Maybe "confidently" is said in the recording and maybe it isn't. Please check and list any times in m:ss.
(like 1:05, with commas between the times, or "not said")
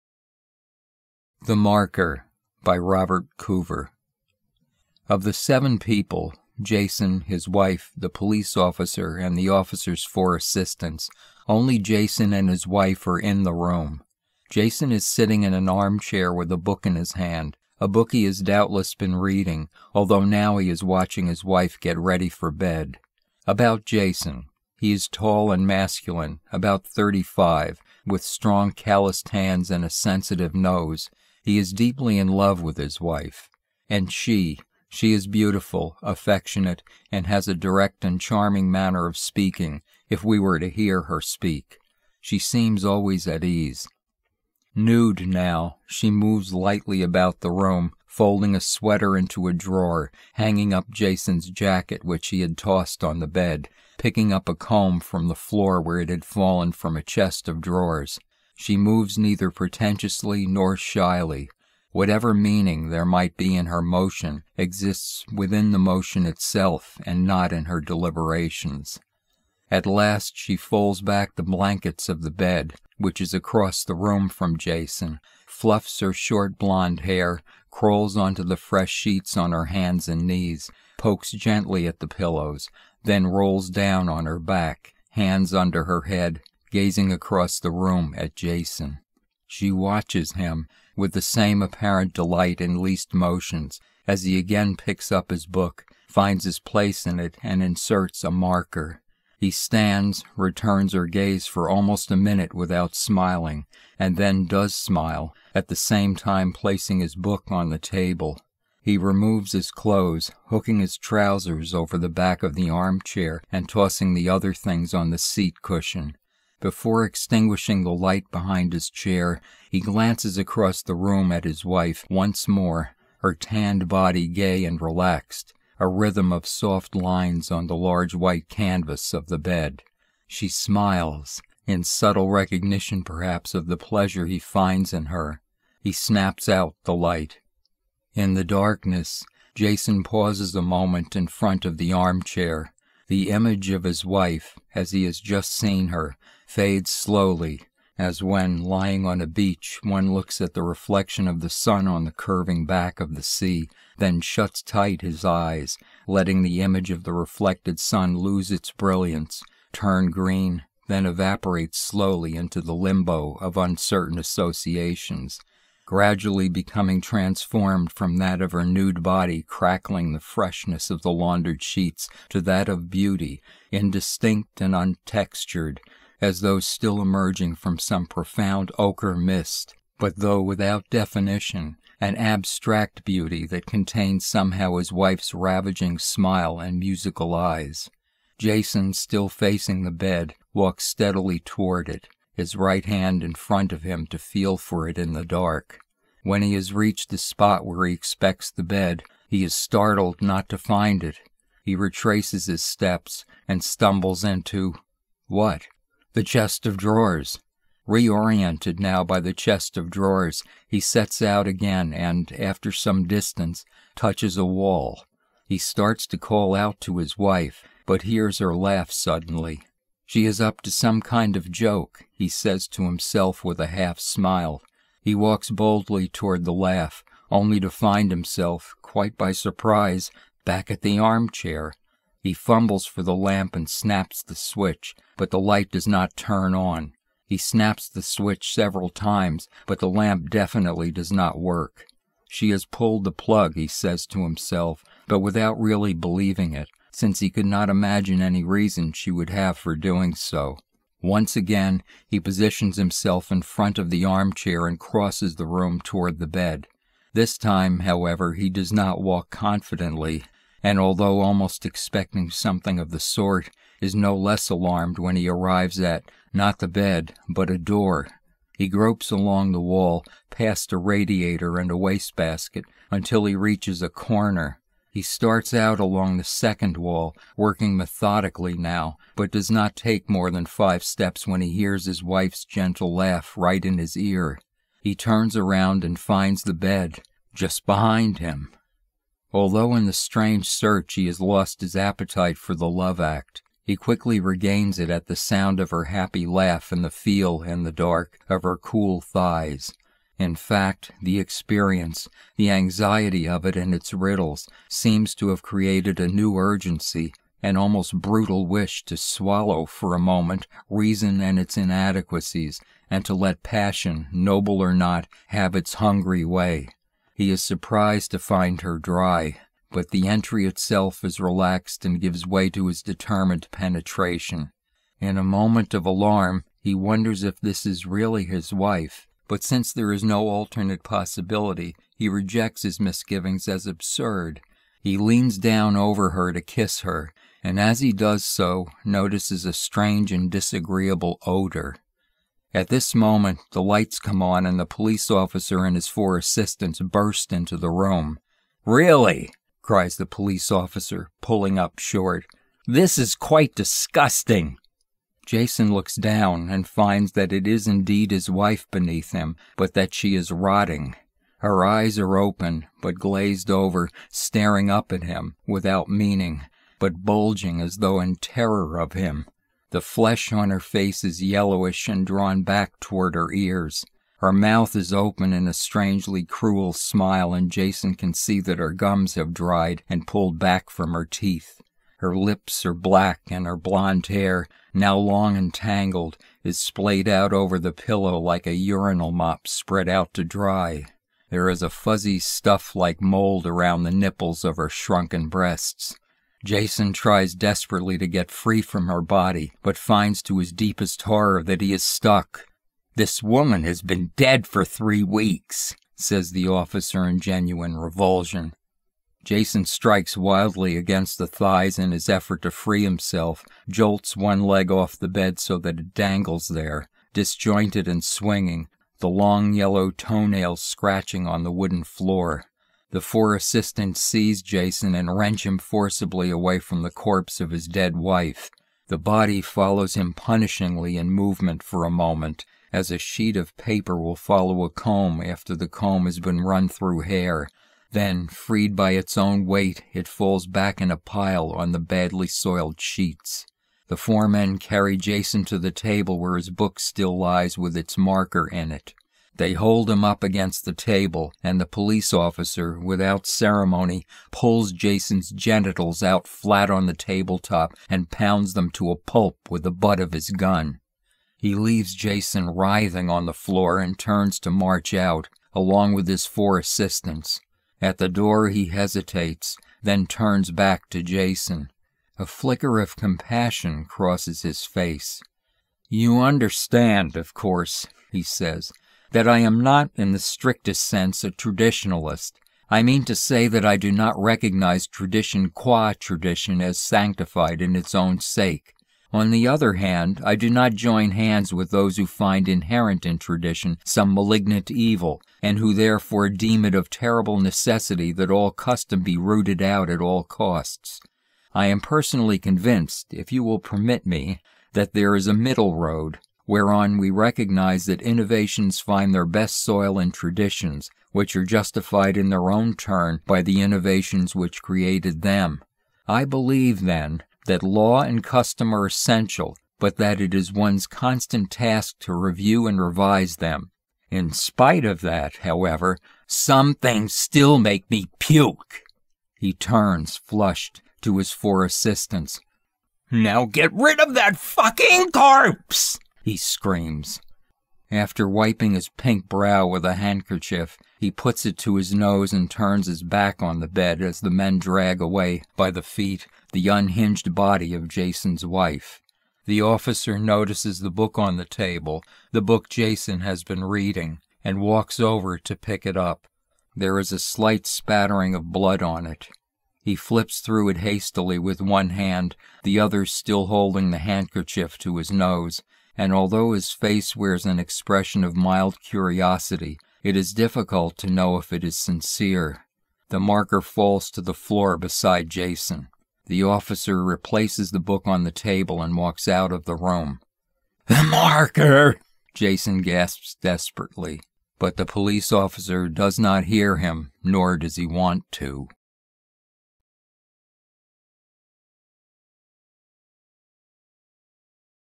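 4:19.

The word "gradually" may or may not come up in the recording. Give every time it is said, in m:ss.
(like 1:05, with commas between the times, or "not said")
2:45.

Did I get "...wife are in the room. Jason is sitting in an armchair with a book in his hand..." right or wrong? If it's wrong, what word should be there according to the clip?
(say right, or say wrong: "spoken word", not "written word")
right.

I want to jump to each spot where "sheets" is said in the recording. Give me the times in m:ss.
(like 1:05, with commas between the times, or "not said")
1:18, 2:51, 7:12, 7:22.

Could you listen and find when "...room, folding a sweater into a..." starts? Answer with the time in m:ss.
0:47.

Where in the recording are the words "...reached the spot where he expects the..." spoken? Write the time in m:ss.
3:16.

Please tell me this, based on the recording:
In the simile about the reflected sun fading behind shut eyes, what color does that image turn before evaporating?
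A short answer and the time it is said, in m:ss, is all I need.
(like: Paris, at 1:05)
Green, at 2:40.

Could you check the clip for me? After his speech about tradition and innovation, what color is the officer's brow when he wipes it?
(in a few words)
Pink.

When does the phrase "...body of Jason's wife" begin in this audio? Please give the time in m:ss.
9:07.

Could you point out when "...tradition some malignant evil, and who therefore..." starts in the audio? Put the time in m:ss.
8:13.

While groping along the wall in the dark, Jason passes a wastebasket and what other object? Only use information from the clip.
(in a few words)
A radiator.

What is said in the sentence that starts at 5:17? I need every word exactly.
He is surprised to find her dry, but the entry itself is relaxed and gives way to his determined penetration.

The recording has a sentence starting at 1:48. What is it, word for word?
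He removes his clothes, hooking his trousers over the back of the armchair and tossing the other things on the seat cushion.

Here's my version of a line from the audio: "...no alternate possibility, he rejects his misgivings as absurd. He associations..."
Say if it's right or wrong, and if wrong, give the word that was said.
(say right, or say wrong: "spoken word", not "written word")
wrong: "leans", not "associations".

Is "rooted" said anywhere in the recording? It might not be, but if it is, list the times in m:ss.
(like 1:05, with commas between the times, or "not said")
8:19.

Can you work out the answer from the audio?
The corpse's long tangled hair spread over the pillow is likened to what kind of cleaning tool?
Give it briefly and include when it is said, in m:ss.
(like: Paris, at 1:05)
A urinal mop, at 6:28.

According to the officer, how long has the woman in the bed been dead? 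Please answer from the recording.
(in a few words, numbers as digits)
3 weeks.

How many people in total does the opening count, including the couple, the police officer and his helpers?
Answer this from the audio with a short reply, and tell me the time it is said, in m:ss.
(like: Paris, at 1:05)
7, at 0:05.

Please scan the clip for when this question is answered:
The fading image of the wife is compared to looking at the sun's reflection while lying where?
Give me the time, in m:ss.
2:29.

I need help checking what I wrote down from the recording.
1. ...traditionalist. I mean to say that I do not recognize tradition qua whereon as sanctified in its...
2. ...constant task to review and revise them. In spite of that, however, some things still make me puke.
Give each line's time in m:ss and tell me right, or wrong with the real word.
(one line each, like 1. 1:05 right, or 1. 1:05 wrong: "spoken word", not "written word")
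1. 8:01 wrong: "tradition", not "whereon"
2. 8:40 right.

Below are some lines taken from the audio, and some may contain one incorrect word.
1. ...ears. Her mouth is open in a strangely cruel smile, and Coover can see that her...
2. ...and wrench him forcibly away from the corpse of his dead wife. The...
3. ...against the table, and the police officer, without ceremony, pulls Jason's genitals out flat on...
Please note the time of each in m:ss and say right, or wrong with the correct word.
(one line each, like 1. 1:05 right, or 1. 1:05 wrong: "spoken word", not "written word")
1. 6:13 wrong: "Jason", not "Coover"
2. 7:04 right
3. 7:30 right.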